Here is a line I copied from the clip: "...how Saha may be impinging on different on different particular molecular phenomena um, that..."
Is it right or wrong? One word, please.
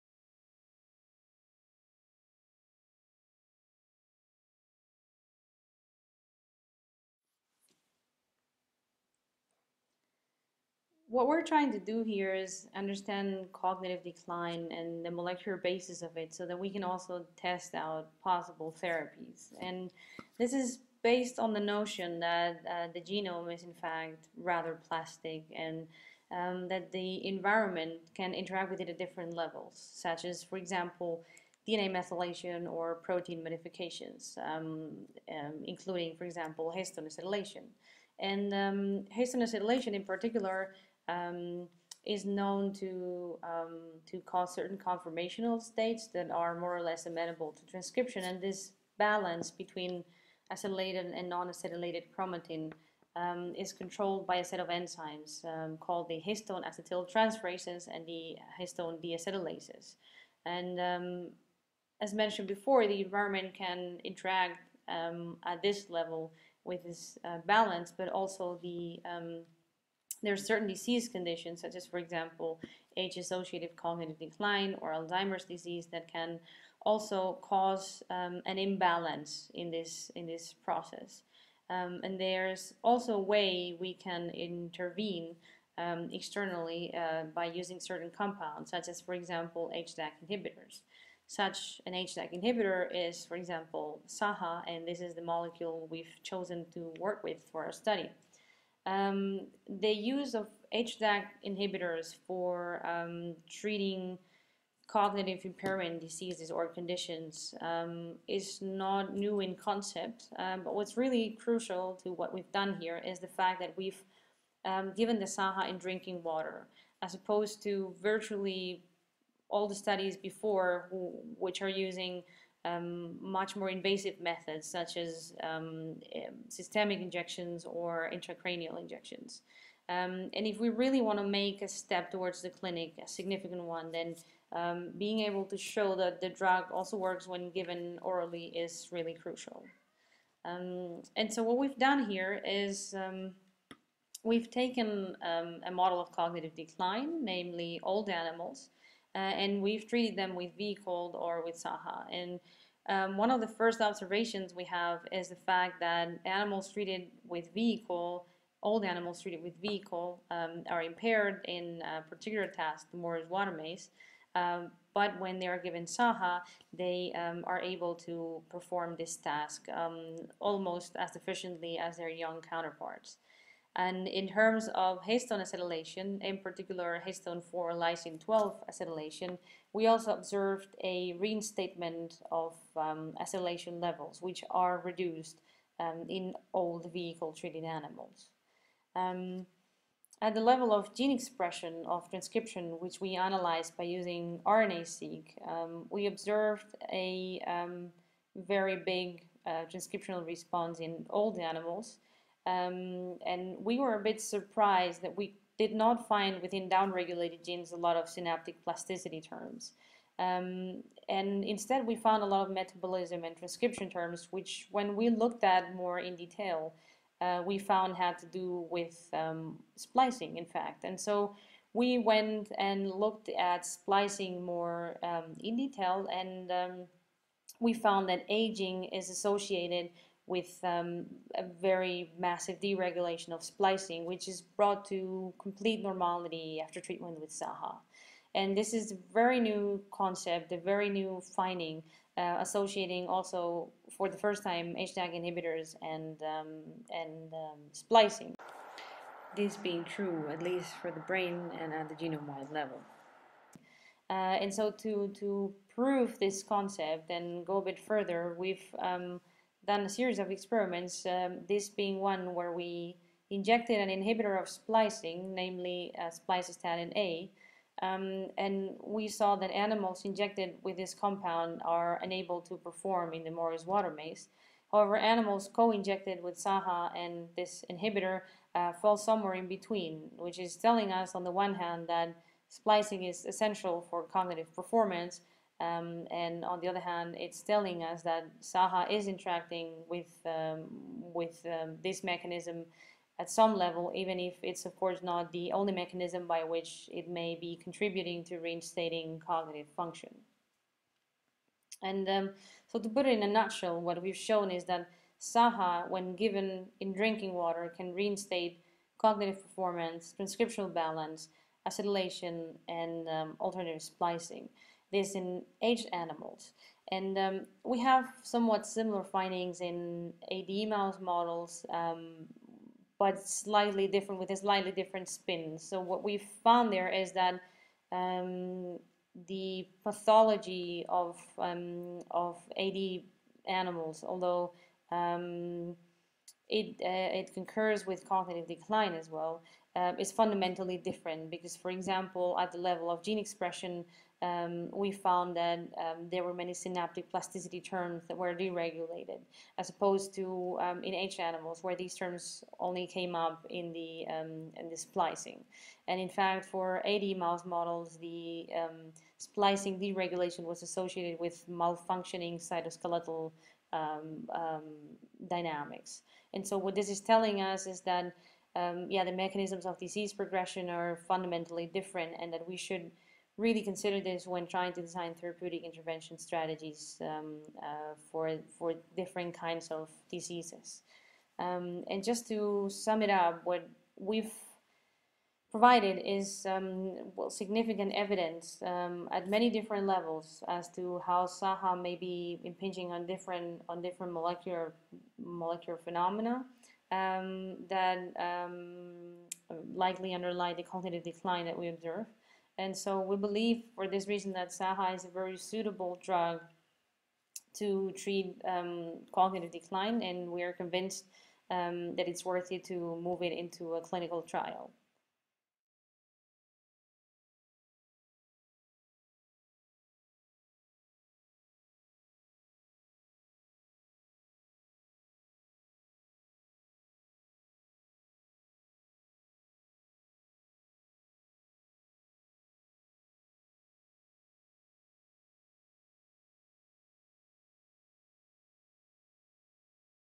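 wrong.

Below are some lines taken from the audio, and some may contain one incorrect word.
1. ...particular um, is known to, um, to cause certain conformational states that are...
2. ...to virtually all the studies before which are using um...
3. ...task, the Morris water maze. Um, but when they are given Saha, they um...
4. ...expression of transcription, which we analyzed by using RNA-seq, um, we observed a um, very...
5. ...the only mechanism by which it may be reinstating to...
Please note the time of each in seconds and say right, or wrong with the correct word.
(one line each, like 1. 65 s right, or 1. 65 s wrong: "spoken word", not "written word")
1. 40 s right
2. 117 s right
3. 162 s right
4. 191 s right
5. 295 s wrong: "contributing", not "reinstating".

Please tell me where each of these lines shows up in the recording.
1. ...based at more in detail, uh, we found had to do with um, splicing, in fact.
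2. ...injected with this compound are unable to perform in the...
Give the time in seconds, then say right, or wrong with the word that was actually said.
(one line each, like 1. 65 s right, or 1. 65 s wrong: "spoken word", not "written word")
1. 215 s wrong: "looked", not "based"
2. 270 s right.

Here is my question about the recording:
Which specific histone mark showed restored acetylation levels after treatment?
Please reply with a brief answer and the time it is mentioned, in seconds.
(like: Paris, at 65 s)
histone 4 lysine 12 acetylation, at 177 s.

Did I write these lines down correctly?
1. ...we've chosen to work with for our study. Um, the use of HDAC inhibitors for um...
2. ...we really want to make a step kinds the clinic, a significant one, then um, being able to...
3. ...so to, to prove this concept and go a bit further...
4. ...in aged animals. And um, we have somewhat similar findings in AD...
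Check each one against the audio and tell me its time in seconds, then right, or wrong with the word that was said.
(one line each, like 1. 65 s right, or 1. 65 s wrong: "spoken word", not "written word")
1. 95 s right
2. 130 s wrong: "towards", not "kinds"
3. 254 s right
4. 315 s right.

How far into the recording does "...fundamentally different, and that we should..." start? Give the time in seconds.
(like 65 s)
371 s.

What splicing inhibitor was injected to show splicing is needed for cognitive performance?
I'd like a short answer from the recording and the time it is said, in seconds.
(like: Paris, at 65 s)
spliceostatin A, at 266 s.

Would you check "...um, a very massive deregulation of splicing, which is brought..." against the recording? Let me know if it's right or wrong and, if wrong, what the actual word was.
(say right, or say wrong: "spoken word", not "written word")
right.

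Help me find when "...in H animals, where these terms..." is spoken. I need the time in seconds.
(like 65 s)
350 s.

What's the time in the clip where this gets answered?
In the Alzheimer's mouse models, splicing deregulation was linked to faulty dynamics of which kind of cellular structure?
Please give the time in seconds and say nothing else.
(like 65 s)
362 s.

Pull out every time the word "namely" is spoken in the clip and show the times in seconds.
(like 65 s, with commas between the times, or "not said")
147 s, 265 s.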